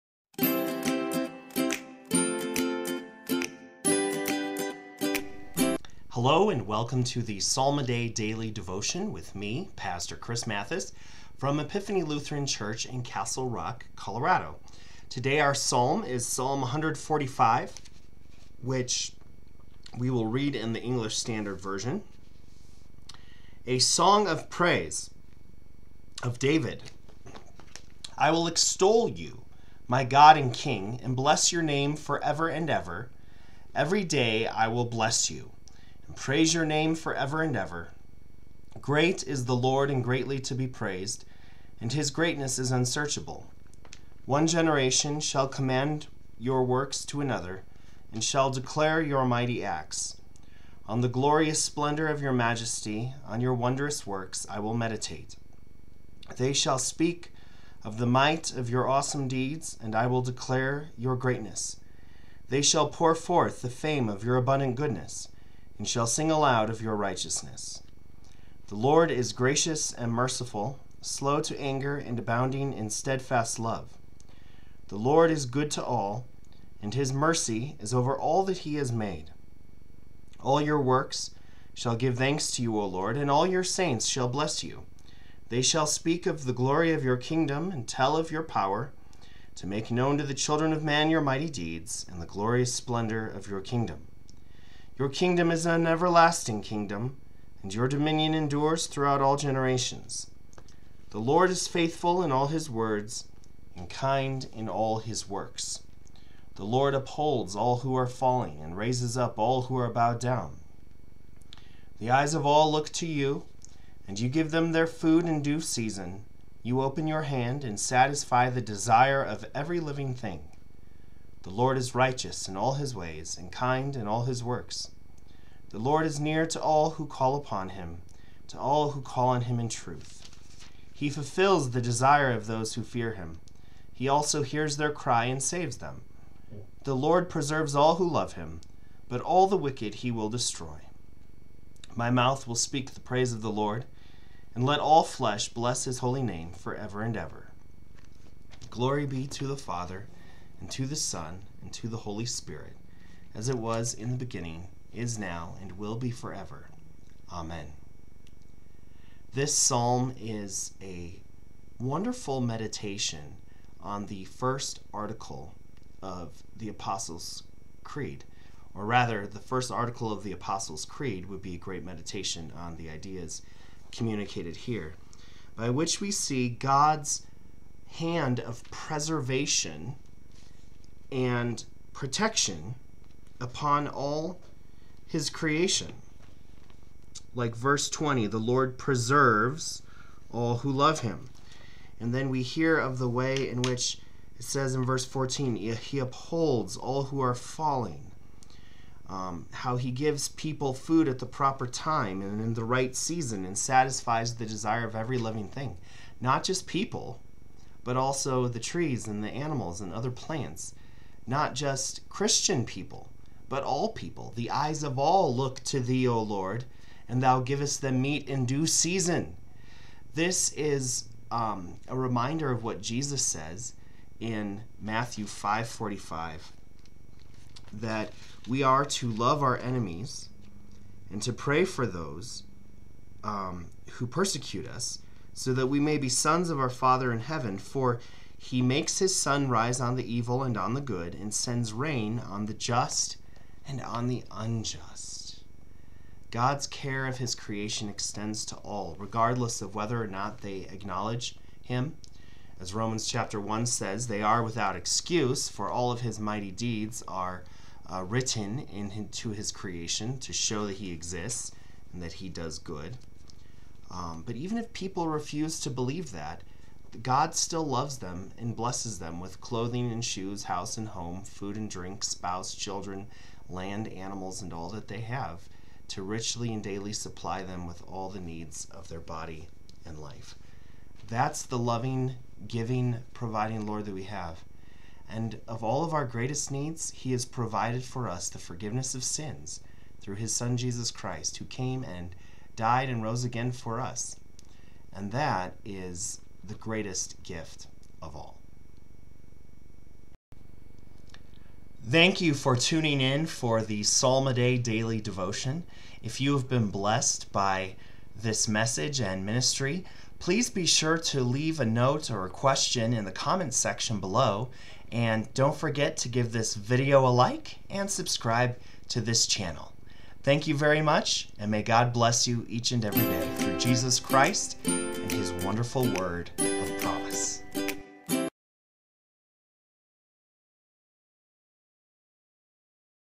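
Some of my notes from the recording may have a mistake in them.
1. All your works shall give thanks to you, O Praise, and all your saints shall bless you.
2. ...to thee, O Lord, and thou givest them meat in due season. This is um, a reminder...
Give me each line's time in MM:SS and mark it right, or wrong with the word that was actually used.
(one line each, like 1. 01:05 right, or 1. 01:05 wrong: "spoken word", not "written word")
1. 01:20 wrong: "Lord", not "Praise"
2. 03:35 right.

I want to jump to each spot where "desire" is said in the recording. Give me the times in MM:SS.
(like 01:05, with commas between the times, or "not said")
01:58, 02:11, 03:24.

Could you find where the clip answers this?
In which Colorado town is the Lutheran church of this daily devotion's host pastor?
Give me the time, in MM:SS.
00:13.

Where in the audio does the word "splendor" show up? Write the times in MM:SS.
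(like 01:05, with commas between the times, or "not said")
00:51, 01:32.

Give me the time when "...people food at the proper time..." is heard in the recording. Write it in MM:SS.
03:20.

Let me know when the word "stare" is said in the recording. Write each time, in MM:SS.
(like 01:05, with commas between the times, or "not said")
not said.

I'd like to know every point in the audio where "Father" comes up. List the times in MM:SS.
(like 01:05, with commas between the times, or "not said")
02:29, 03:56.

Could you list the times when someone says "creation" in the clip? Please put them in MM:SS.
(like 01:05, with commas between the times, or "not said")
03:05, 04:07, 04:19.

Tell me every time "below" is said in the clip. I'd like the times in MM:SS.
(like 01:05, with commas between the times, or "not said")
05:13.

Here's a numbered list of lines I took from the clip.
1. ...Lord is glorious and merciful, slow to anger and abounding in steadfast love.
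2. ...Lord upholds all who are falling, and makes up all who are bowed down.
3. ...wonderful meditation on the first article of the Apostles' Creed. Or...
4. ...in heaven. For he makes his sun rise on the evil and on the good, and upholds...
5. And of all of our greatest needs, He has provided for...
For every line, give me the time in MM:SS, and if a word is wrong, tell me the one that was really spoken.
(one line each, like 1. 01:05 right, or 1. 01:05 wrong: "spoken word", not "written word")
1. 01:08 wrong: "gracious", not "glorious"
2. 01:46 wrong: "raises", not "makes"
3. 02:41 right
4. 03:57 wrong: "sends", not "upholds"
5. 04:45 right.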